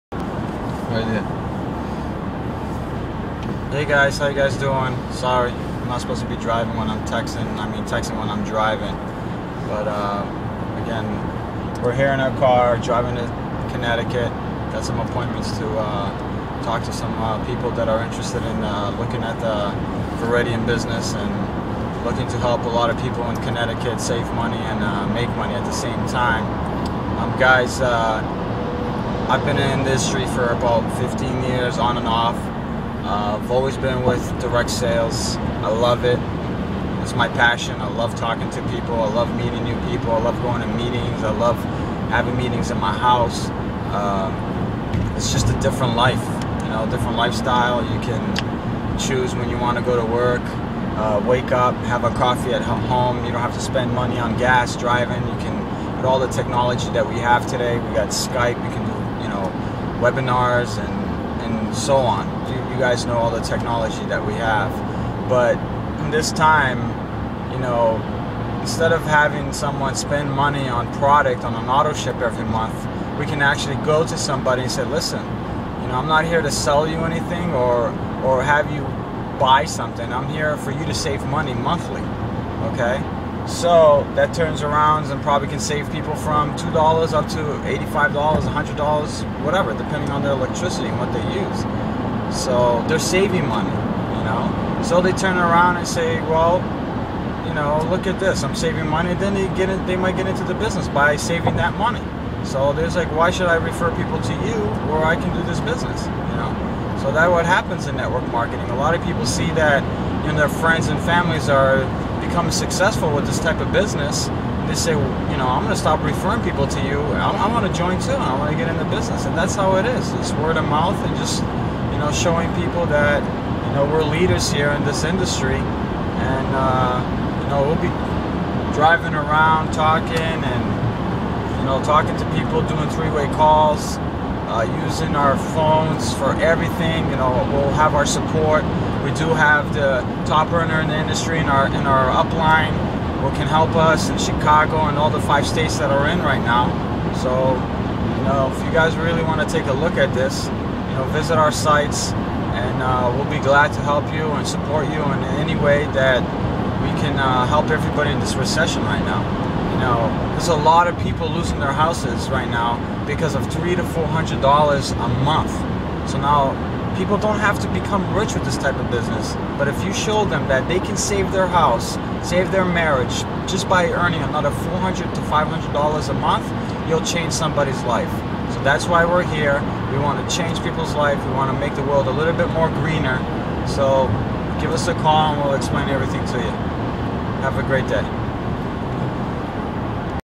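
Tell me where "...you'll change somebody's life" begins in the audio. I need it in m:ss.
2:56.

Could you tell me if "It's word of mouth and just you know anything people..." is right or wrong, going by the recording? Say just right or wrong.
wrong.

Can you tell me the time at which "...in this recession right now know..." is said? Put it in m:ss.
2:38.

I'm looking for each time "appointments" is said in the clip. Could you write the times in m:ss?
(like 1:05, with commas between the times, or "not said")
0:14.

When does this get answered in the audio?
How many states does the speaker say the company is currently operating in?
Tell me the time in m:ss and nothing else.
2:25.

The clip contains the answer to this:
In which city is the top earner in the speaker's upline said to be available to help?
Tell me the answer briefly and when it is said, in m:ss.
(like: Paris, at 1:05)
Chicago, at 2:24.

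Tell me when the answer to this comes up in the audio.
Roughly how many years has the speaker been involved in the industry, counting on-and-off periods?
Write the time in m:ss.
0:30.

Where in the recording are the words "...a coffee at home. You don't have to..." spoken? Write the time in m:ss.
0:52.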